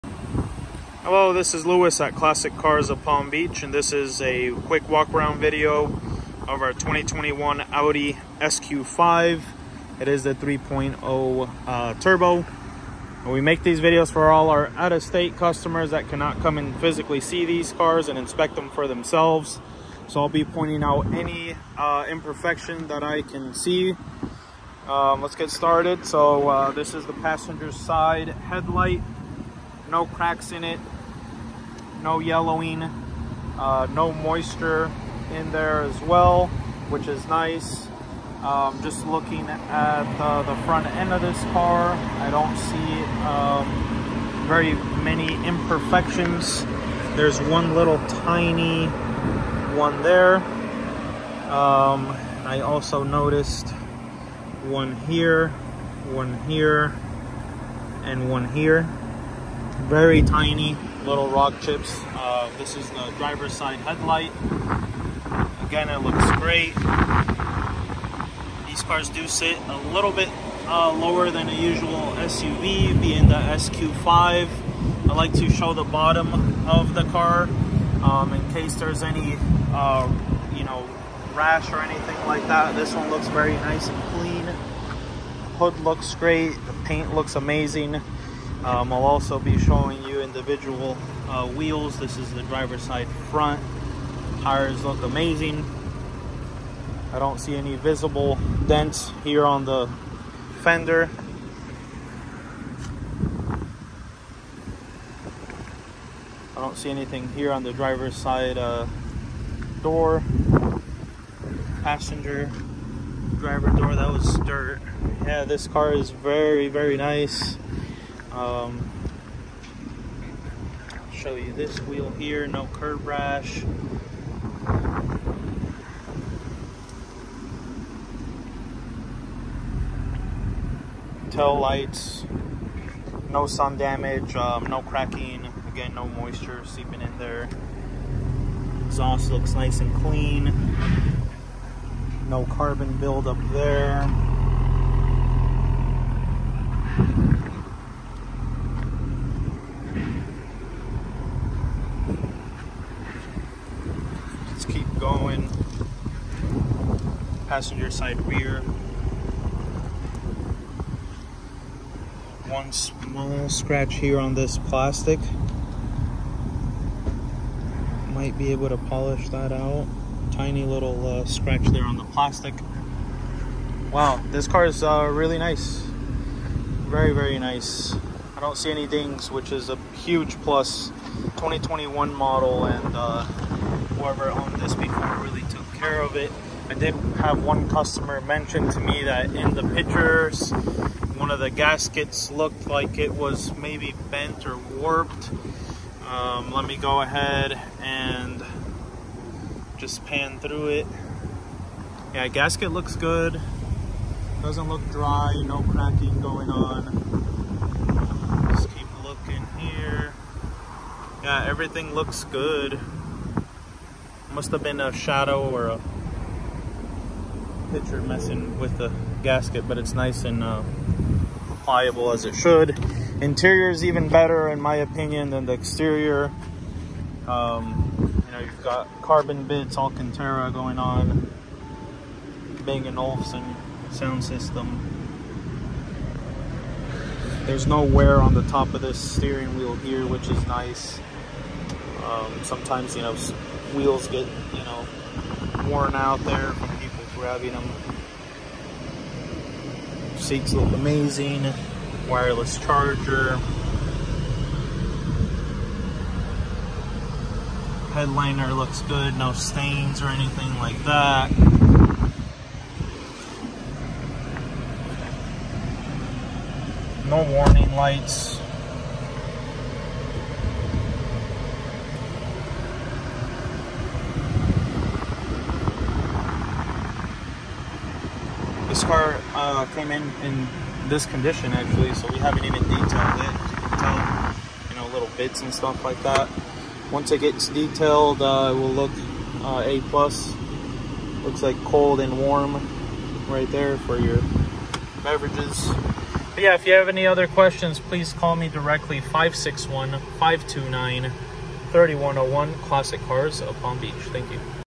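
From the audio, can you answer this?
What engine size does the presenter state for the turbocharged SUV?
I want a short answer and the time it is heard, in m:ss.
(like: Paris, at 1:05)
3.0, at 0:10.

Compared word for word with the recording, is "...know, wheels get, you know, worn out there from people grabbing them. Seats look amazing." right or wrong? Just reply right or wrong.
right.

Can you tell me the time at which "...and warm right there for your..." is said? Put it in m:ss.
4:51.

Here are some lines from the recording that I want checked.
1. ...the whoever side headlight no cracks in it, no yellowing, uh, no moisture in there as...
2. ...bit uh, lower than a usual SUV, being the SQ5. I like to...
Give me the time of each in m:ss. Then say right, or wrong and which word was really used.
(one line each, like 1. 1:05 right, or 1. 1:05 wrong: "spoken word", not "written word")
1. 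0:27 wrong: "passenger", not "whoever"
2. 1:10 right.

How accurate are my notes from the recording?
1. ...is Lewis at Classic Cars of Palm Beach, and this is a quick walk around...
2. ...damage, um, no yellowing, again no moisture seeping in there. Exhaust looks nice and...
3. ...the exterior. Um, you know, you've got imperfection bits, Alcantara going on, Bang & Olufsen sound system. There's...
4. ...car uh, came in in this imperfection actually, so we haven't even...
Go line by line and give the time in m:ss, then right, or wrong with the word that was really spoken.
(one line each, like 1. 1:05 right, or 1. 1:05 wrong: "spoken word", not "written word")
1. 0:01 right
2. 2:13 wrong: "cracking", not "yellowing"
3. 3:45 wrong: "carbon", not "imperfection"
4. 4:38 wrong: "condition", not "imperfection".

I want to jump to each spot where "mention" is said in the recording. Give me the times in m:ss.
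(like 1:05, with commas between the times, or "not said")
3:08.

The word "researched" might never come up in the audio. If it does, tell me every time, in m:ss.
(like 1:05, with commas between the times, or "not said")
not said.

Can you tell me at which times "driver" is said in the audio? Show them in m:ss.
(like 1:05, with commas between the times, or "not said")
1:03, 1:32, 1:47, 1:53.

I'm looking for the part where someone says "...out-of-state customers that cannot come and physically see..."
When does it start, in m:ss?
0:14.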